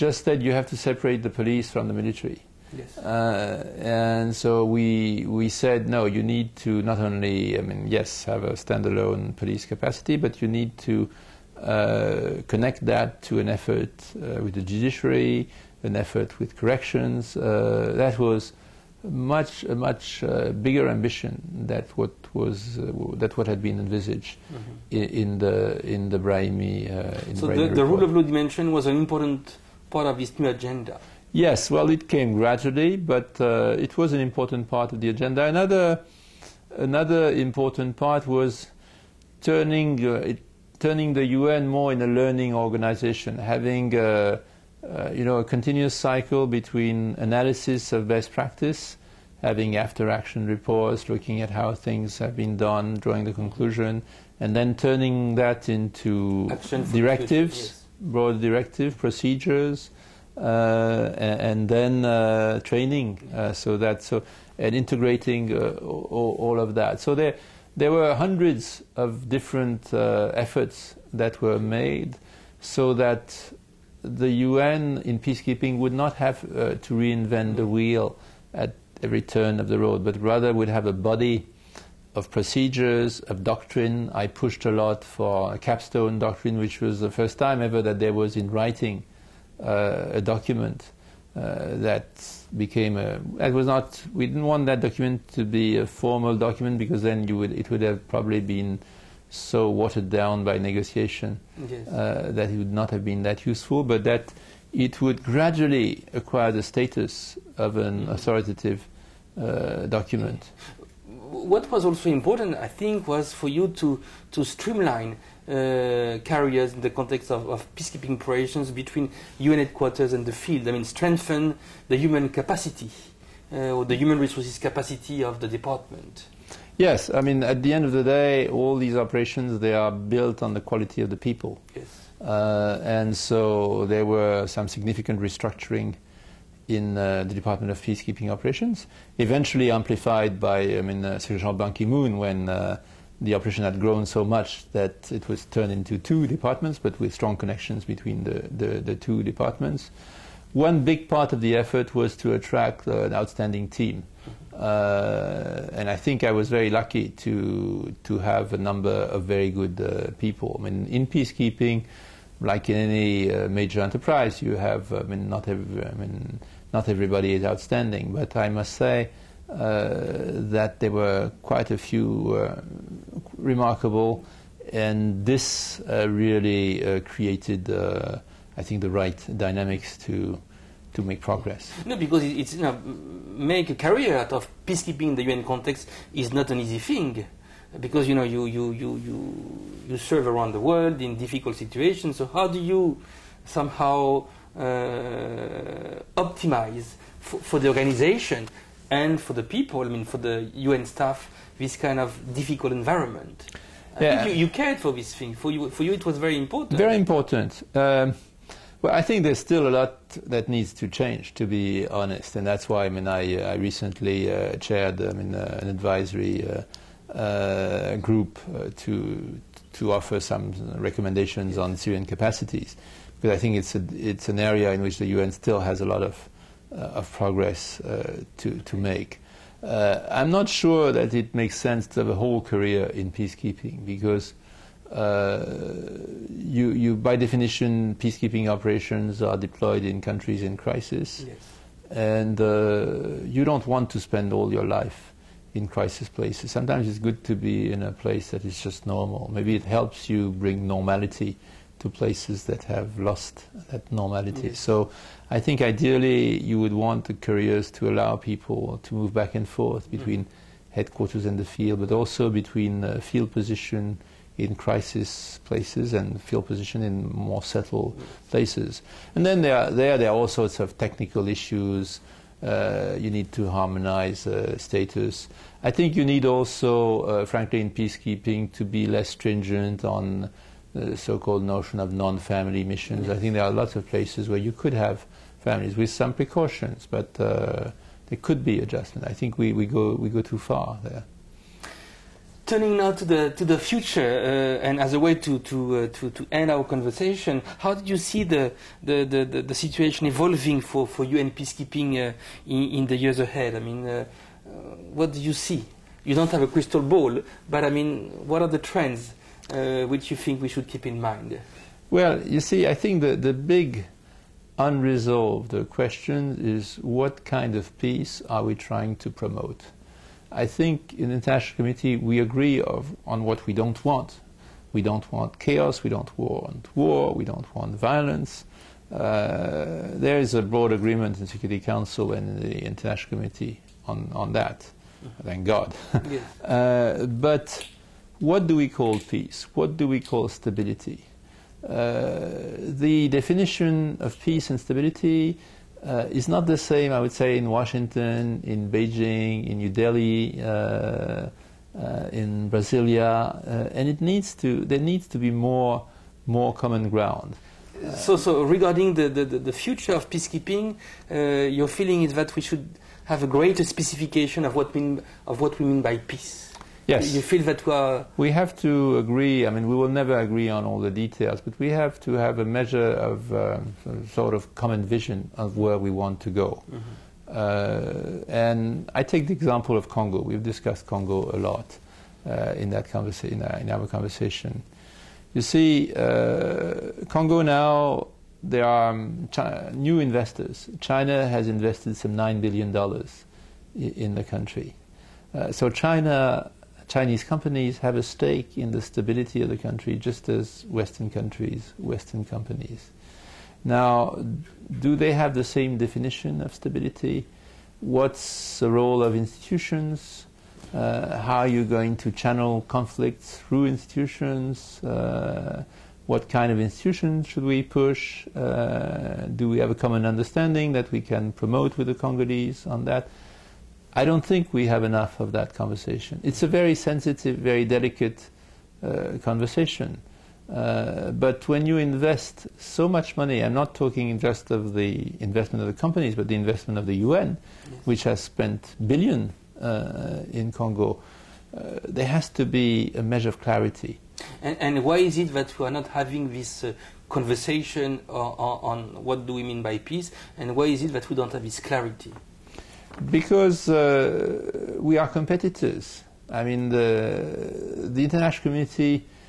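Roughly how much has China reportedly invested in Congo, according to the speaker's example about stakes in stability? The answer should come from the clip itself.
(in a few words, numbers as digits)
9 billion dollars.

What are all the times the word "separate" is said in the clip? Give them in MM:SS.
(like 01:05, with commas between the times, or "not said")
00:00.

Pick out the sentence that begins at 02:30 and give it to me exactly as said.
One big part of the effort was to attract uh, an outstanding team.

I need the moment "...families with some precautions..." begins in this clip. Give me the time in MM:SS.
04:45.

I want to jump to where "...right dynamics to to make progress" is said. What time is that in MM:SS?
02:58.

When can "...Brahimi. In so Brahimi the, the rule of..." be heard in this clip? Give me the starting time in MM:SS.
00:26.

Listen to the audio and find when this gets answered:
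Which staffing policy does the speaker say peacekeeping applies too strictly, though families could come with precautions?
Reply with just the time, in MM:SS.
04:41.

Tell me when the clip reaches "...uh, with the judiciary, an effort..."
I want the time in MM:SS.
00:14.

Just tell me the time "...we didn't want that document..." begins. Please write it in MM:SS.
01:34.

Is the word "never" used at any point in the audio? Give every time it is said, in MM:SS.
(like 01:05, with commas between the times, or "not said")
06:09.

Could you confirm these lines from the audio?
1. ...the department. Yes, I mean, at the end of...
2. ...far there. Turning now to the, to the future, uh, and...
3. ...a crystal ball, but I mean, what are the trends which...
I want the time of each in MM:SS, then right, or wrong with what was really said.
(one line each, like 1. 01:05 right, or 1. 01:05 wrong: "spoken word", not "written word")
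1. 02:05 right
2. 04:50 right
3. 05:06 right.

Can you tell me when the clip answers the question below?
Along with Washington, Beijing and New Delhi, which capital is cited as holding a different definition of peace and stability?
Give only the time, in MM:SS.
05:52.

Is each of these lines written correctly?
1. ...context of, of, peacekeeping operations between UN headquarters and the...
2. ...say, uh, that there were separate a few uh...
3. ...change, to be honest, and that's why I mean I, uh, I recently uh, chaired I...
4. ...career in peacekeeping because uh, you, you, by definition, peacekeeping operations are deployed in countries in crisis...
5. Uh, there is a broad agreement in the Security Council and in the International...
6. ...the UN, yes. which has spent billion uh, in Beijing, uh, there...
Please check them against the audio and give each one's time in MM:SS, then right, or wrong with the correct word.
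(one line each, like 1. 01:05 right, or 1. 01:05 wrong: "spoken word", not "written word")
1. 01:56 right
2. 02:48 wrong: "quite", not "separate"
3. 03:30 right
4. 03:52 right
5. 05:28 right
6. 07:16 wrong: "Congo", not "Beijing".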